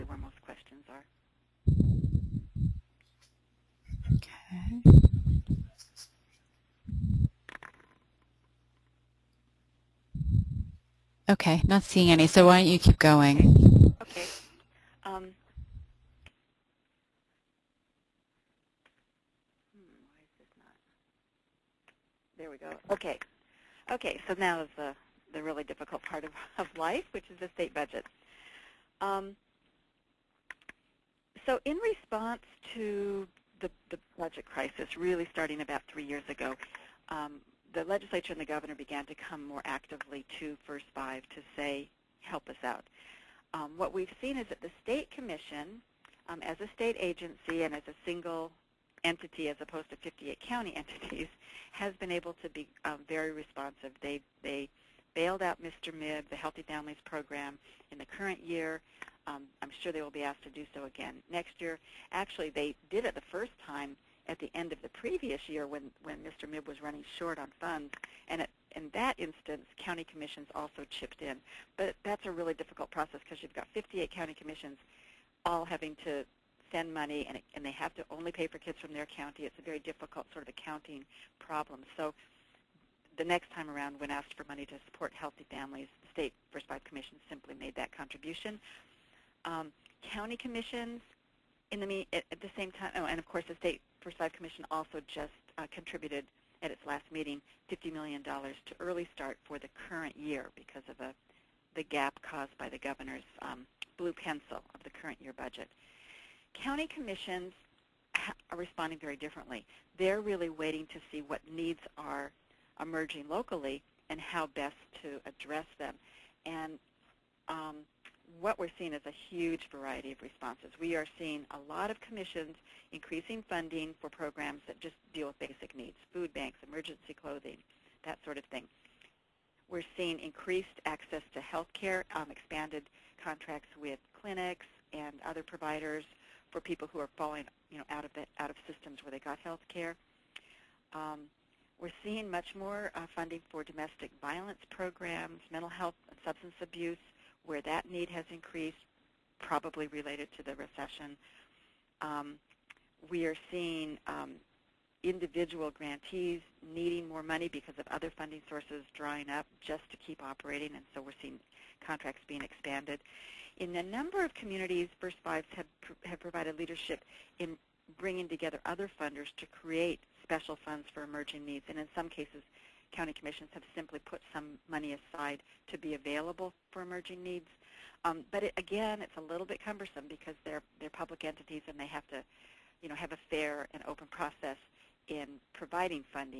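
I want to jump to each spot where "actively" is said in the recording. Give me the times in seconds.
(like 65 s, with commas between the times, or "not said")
39 s.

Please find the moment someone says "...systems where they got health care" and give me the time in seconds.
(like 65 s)
138 s.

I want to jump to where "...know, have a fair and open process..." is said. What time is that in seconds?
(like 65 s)
182 s.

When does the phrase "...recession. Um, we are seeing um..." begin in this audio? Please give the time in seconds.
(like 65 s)
150 s.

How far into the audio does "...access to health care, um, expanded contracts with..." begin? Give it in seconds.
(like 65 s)
130 s.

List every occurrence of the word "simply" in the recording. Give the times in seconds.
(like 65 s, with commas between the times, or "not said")
87 s, 173 s.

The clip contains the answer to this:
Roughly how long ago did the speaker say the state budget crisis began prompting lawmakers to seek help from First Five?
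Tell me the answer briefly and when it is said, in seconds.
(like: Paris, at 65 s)
about 3 years ago, at 35 s.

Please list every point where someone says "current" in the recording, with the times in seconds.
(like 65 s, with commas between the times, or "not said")
58 s, 99 s, 104 s.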